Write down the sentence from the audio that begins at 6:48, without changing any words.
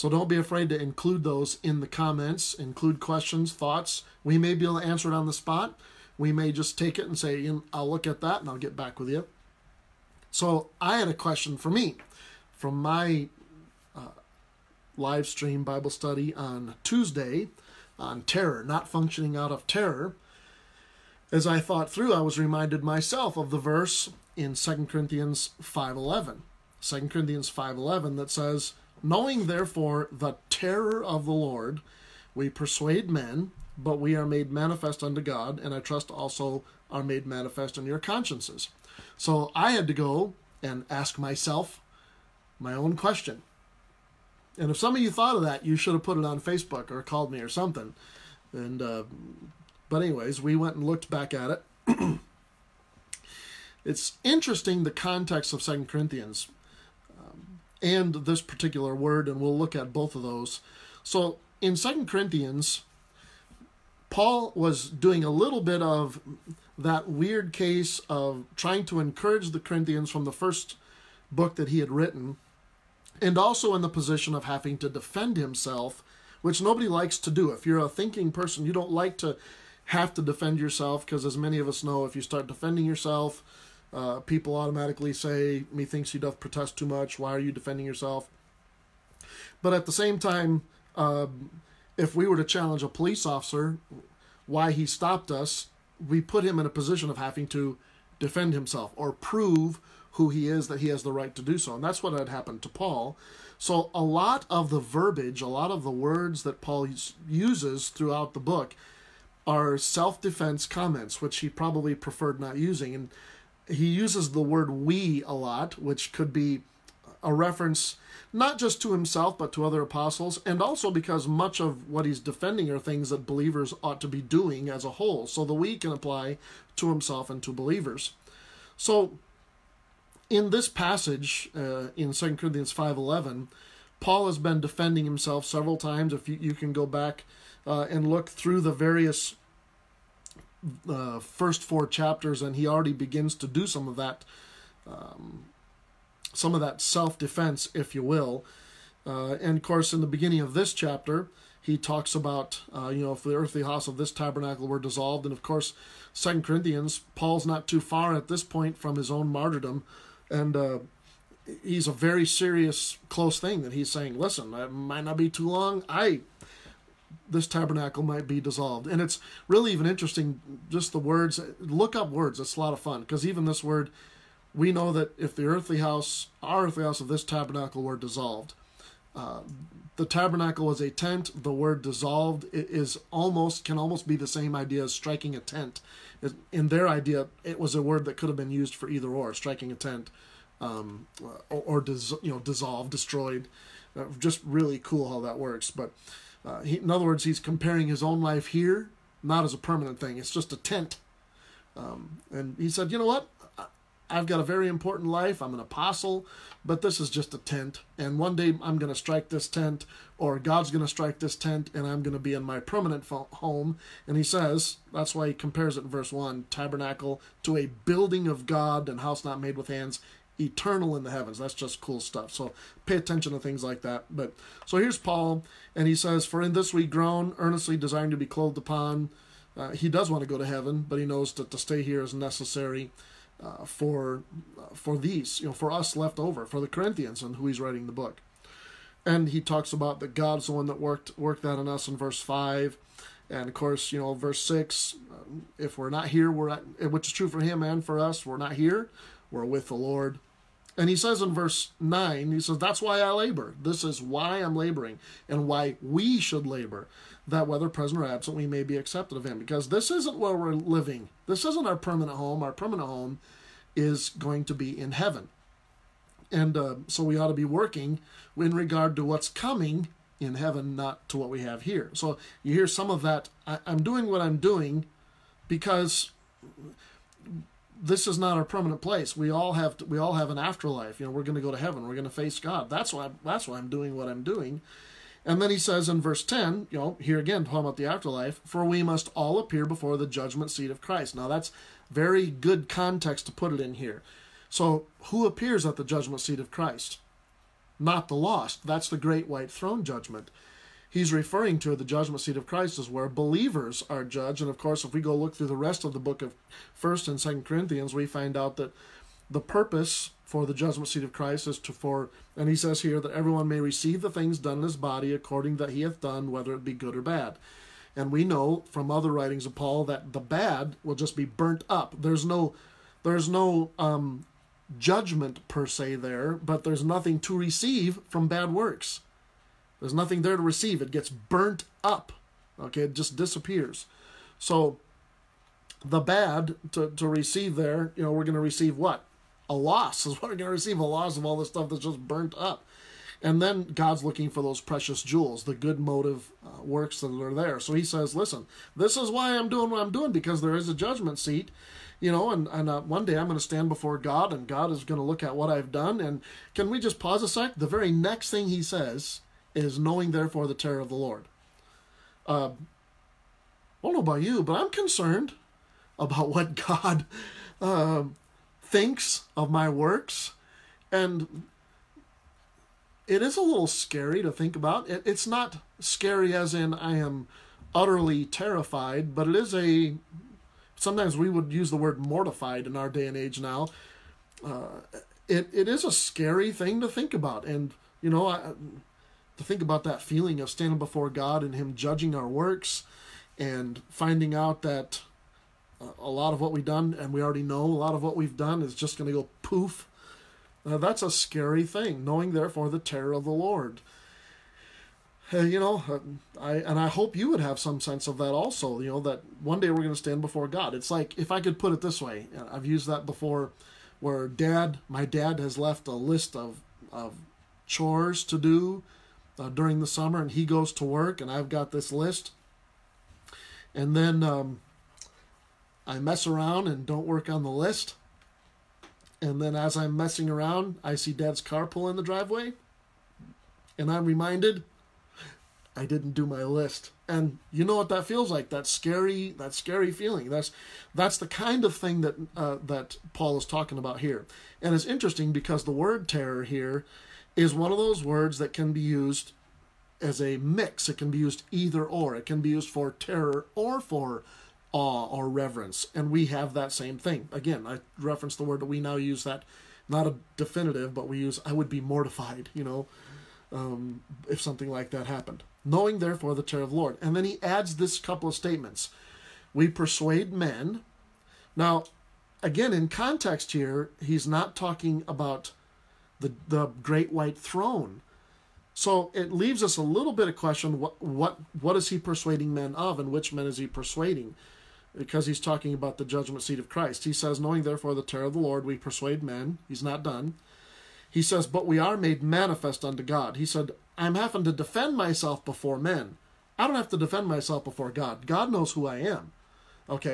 You know that one day we're going to stand before God.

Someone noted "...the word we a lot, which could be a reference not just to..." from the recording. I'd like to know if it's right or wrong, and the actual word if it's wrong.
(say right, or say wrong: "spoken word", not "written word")
right.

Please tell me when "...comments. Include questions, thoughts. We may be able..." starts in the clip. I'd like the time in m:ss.
0:01.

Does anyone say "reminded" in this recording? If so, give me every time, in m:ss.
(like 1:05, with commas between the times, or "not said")
0:22, 7:14.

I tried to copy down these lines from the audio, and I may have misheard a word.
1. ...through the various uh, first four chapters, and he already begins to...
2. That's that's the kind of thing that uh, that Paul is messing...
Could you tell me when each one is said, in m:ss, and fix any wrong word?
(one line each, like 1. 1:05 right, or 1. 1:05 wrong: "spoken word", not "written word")
1. 2:18 right
2. 7:20 wrong: "talking", not "messing".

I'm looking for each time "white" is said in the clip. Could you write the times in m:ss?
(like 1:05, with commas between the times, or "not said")
4:59, 7:57.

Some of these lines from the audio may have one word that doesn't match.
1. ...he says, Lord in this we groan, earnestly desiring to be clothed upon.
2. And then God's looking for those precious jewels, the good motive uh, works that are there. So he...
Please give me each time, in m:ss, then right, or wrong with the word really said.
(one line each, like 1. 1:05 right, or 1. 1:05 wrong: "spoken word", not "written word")
1. 3:45 wrong: "For", not "Lord"
2. 5:43 right.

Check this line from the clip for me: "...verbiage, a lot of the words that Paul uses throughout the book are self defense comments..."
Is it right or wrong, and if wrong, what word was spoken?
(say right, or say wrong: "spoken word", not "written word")
right.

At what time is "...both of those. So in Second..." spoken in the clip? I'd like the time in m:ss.
0:59.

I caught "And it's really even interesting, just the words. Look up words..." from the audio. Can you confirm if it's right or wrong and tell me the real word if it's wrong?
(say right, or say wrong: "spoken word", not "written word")
right.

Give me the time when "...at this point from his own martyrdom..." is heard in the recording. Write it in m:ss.
2:38.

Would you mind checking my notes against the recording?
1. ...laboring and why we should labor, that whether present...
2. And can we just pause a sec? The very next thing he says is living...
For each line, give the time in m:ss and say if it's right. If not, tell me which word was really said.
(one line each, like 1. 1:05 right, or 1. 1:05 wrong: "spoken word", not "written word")
1. 4:14 right
2. 5:55 wrong: "knowing", not "living".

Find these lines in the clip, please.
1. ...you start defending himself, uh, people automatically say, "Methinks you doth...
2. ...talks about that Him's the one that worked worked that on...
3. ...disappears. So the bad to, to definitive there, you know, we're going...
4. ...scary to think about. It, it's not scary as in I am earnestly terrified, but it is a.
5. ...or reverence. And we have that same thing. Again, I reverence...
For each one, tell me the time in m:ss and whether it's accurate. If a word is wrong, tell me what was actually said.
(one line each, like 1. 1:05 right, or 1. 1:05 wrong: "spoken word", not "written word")
1. 1:22 wrong: "yourself", not "himself"
2. 3:59 wrong: "God", not "Him"
3. 5:33 wrong: "receive", not "definitive"
4. 6:13 wrong: "utterly", not "earnestly"
5. 7:35 wrong: "reference", not "reverence".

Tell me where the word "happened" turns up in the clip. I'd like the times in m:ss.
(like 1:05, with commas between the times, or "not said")
1:42, 7:45.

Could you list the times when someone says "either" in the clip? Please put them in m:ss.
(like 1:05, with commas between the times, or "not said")
3:08, 7:31.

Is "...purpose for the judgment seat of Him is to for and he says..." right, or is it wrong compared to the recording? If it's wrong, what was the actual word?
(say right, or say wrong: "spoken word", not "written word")
wrong: "Christ", not "Him".